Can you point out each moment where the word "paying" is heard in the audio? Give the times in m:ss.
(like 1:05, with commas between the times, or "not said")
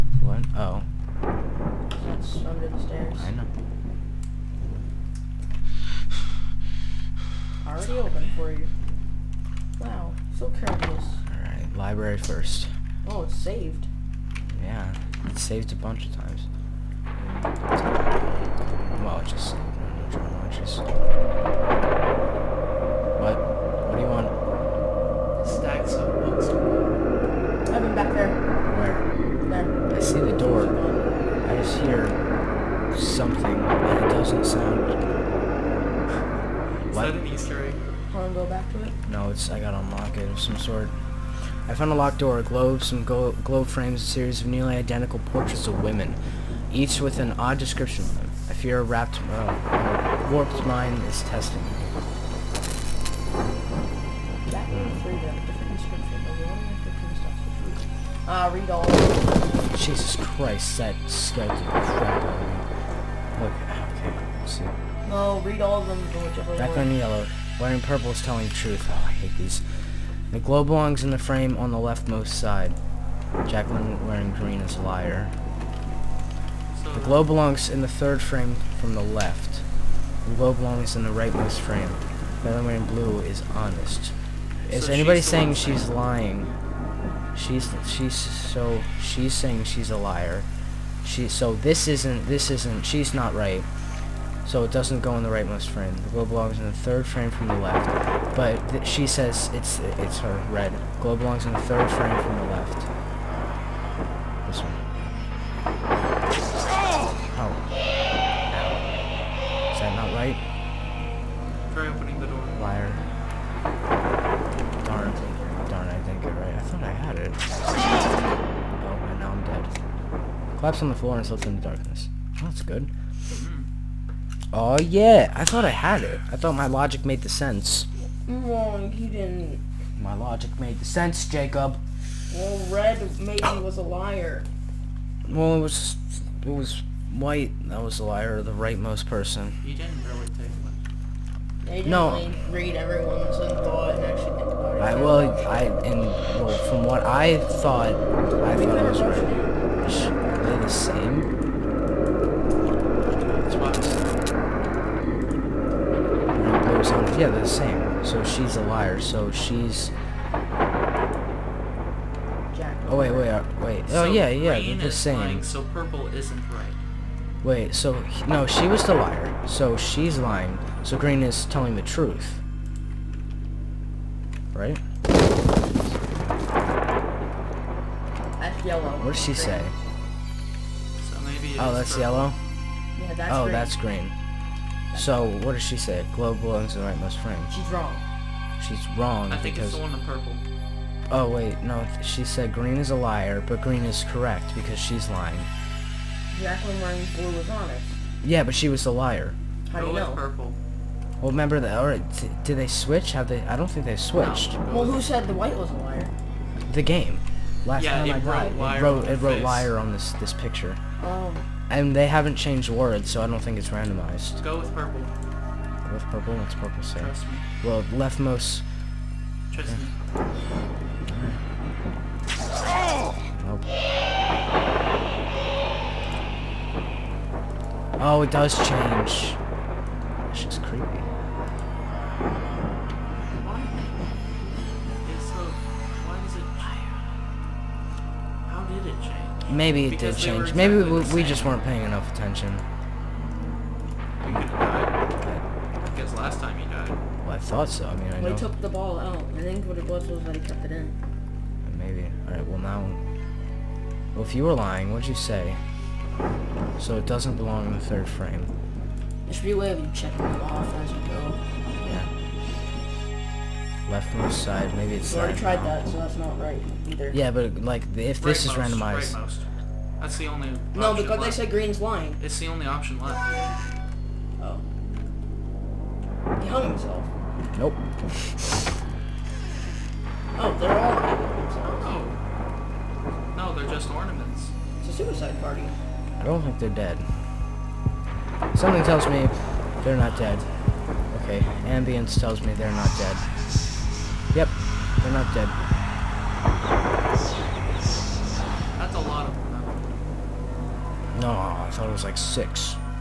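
4:01.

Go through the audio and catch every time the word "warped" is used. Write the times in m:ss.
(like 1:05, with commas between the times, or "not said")
0:50.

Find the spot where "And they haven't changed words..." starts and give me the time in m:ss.
3:31.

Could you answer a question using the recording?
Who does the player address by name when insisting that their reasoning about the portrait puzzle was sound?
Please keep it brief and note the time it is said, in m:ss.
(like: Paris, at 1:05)
Jacob, at 2:11.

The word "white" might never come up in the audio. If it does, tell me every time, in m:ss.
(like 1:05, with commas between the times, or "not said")
2:17, 3:25.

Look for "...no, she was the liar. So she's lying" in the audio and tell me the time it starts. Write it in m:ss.
2:48.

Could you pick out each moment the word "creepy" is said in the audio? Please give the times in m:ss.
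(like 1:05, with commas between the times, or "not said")
3:50.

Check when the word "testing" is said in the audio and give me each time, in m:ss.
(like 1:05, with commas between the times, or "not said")
0:51.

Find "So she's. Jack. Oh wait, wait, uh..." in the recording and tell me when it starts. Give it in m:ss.
2:38.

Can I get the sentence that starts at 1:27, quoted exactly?
She's she's so she's saying she's a liar.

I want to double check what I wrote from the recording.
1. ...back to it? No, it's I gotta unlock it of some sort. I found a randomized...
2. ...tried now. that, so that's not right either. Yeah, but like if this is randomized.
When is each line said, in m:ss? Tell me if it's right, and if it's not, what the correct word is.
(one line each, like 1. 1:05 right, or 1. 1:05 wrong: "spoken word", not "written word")
1. 0:38 wrong: "locked", not "randomized"
2. 4:25 right.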